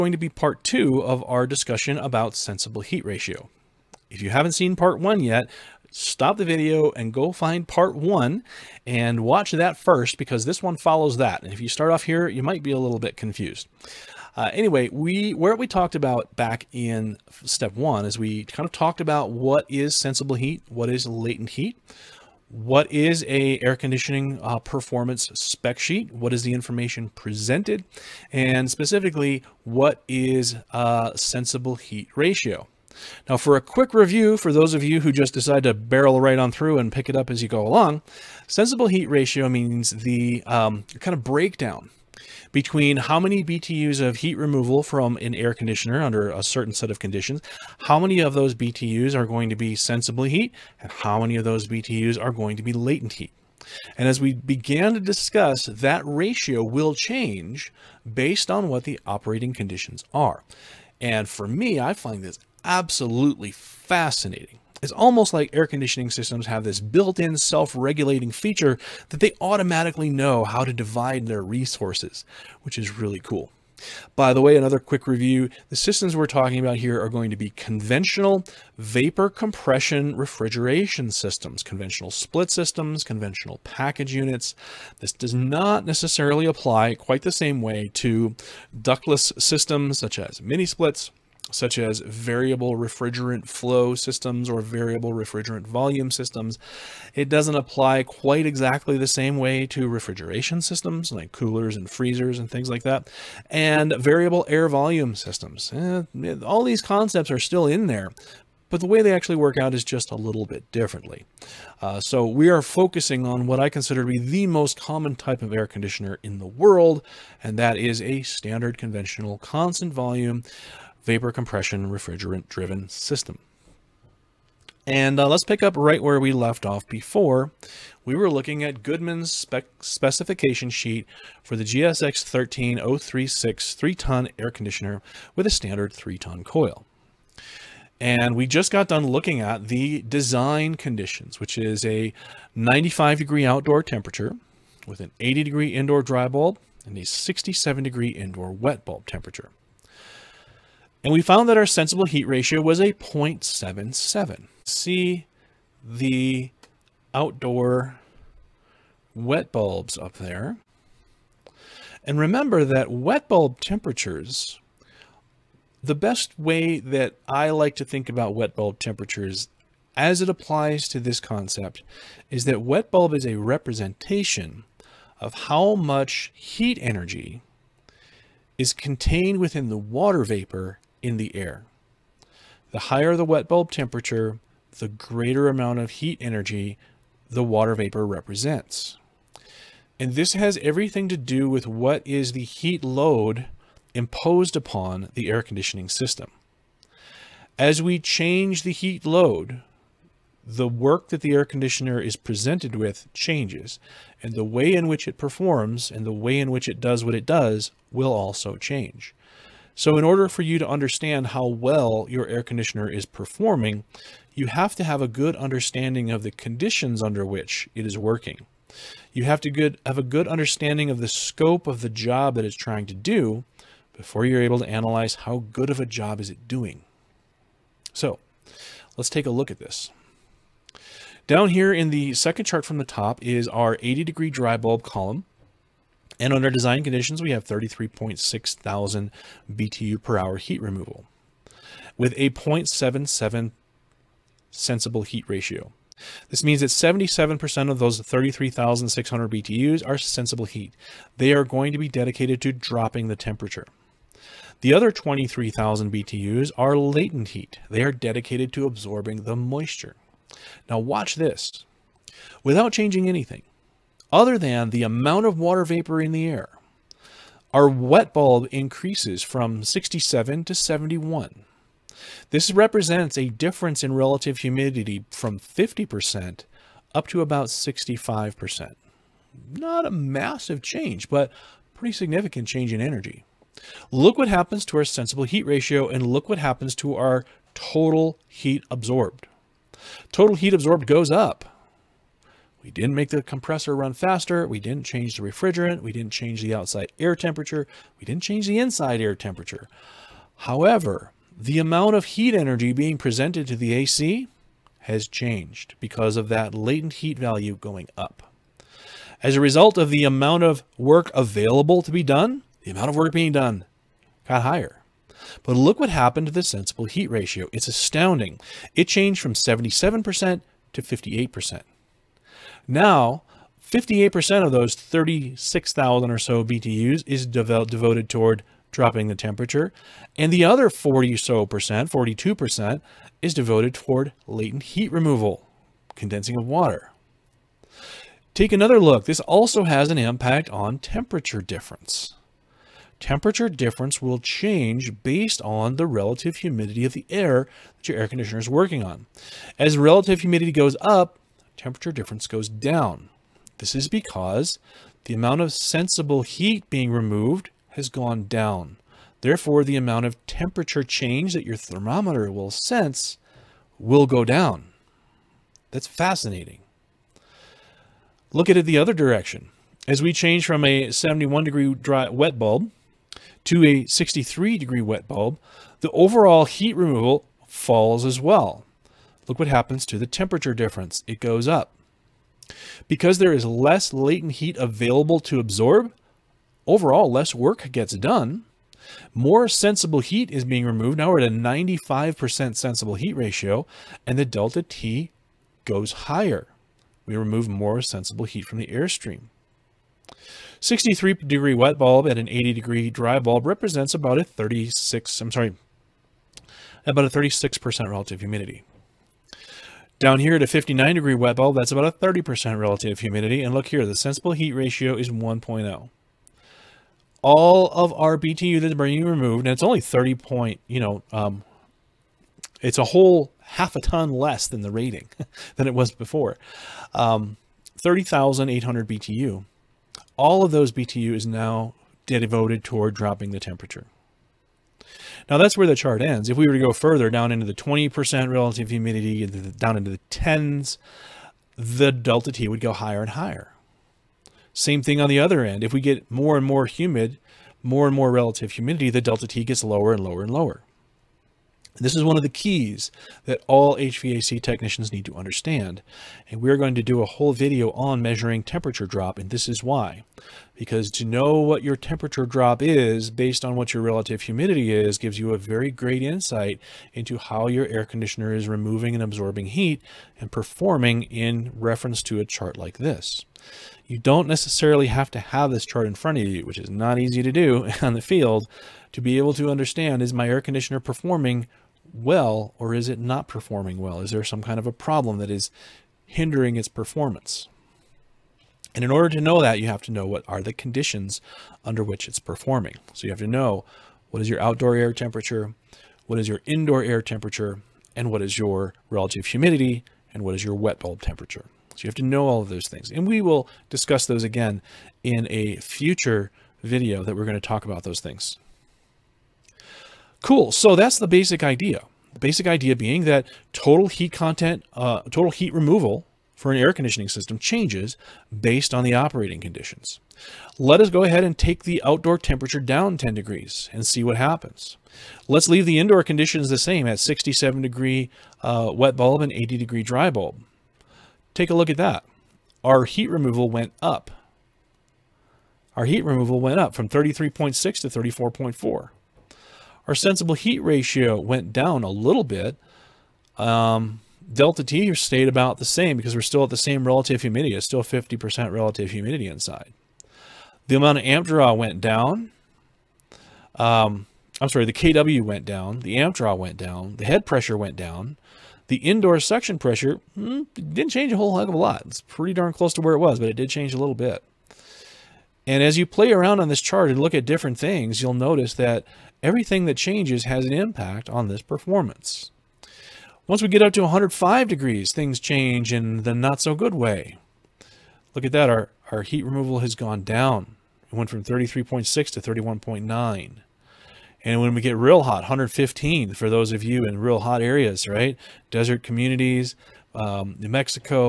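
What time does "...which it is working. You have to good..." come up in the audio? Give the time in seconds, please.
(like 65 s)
217 s.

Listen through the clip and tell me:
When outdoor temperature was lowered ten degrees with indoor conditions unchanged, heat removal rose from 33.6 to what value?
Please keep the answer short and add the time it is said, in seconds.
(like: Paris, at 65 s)
34.4, at 537 s.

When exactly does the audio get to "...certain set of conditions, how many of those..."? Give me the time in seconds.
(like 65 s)
46 s.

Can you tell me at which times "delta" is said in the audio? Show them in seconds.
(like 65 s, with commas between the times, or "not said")
394 s, 441 s, 449 s, 544 s.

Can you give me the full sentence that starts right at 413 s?
And look here, the sensible heat ratio is 1.0.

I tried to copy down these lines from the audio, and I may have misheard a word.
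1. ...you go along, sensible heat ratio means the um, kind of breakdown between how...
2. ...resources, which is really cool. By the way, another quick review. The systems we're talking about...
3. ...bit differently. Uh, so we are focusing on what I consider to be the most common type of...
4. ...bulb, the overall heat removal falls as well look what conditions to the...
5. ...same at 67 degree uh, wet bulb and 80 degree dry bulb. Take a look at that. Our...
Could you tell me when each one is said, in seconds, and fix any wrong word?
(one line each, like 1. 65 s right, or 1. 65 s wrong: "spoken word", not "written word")
1. 37 s right
2. 71 s right
3. 110 s right
4. 375 s wrong: "happens", not "conditions"
5. 526 s right.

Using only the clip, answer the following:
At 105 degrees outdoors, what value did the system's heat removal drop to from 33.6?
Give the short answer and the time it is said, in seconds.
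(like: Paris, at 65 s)
31.9, at 582 s.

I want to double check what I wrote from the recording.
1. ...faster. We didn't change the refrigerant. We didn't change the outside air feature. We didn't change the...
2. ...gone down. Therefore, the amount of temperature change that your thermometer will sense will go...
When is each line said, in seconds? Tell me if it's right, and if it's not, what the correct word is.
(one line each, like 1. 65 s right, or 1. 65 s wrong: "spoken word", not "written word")
1. 293 s wrong: "temperature", not "feature"
2. 357 s right.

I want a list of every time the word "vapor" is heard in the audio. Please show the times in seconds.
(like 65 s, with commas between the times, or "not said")
78 s, 121 s, 180 s, 187 s, 265 s.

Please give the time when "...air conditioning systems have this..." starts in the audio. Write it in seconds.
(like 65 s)
65 s.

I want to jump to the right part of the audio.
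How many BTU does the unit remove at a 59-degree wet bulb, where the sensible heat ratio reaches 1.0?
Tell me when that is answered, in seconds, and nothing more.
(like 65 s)
427 s.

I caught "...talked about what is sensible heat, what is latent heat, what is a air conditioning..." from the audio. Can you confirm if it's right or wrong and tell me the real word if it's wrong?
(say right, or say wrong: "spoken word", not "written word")
right.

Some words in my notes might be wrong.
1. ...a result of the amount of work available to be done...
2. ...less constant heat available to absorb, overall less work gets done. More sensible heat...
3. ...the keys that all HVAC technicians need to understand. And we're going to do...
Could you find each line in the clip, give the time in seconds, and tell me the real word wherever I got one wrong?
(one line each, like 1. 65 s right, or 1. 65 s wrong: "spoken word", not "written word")
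1. 309 s right
2. 383 s wrong: "latent", not "constant"
3. 452 s right.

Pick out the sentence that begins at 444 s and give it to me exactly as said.
Same thing on the other end.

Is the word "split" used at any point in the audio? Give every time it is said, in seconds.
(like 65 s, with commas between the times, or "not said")
82 s, 90 s.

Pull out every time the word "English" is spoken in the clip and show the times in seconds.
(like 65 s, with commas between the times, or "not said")
not said.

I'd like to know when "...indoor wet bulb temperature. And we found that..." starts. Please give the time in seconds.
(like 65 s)
148 s.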